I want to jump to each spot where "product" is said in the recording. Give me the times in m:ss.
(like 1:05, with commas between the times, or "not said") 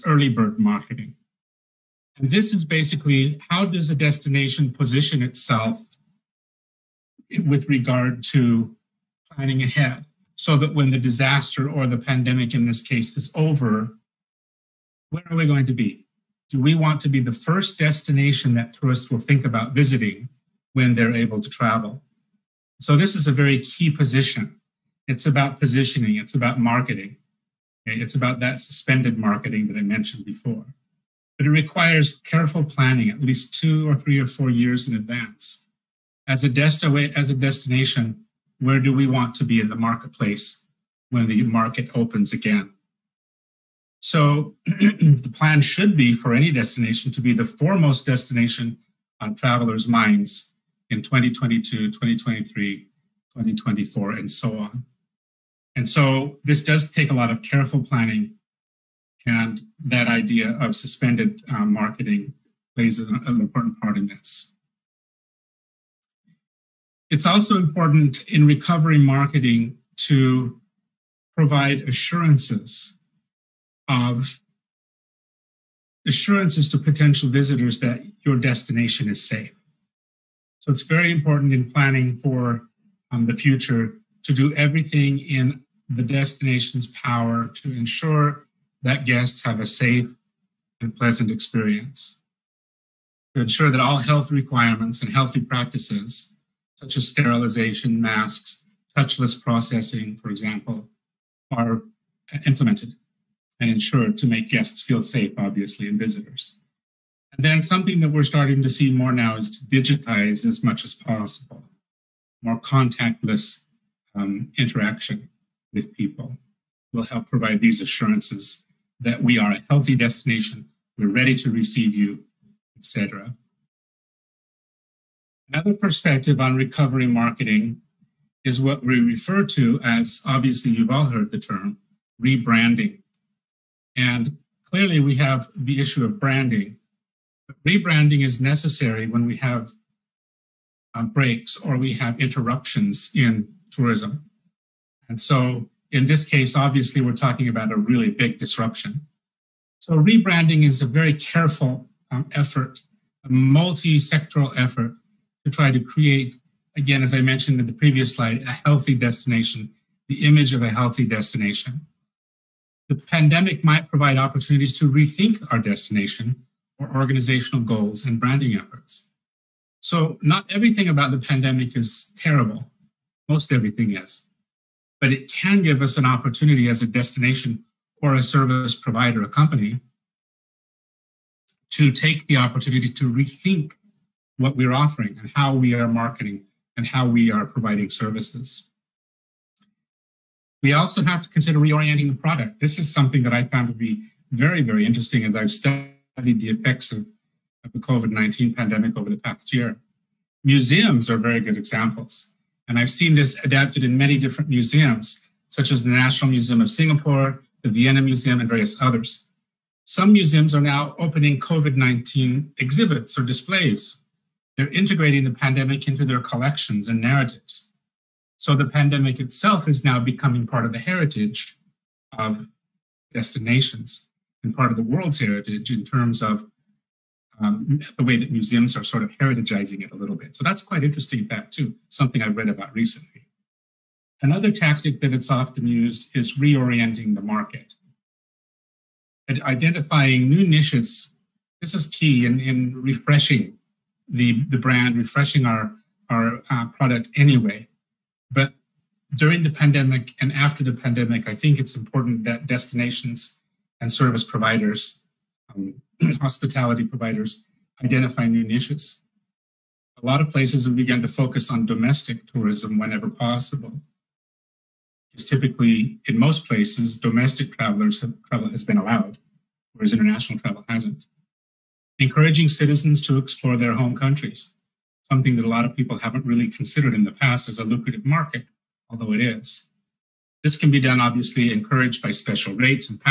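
3:12, 4:06.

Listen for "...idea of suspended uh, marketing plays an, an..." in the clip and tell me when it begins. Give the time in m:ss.
1:00.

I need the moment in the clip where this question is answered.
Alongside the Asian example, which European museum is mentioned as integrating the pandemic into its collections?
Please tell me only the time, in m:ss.
3:27.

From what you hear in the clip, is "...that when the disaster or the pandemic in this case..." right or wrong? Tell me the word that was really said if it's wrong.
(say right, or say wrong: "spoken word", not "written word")
right.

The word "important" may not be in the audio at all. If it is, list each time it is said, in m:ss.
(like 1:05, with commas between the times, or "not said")
1:03, 1:07, 1:21, 4:11.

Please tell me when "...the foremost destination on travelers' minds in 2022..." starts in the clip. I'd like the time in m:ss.
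0:47.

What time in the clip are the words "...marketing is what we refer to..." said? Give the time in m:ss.
2:07.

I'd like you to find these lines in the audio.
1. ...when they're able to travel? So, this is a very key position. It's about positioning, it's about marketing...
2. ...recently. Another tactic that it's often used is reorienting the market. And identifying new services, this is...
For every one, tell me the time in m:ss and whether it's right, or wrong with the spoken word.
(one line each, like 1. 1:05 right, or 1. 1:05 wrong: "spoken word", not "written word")
1. 0:20 right
2. 3:52 wrong: "niches", not "services".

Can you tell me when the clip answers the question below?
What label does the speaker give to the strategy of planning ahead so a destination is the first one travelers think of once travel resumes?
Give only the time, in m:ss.
0:00.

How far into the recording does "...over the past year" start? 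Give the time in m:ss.
3:18.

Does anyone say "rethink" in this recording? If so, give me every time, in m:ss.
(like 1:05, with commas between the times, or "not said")
2:44, 3:03.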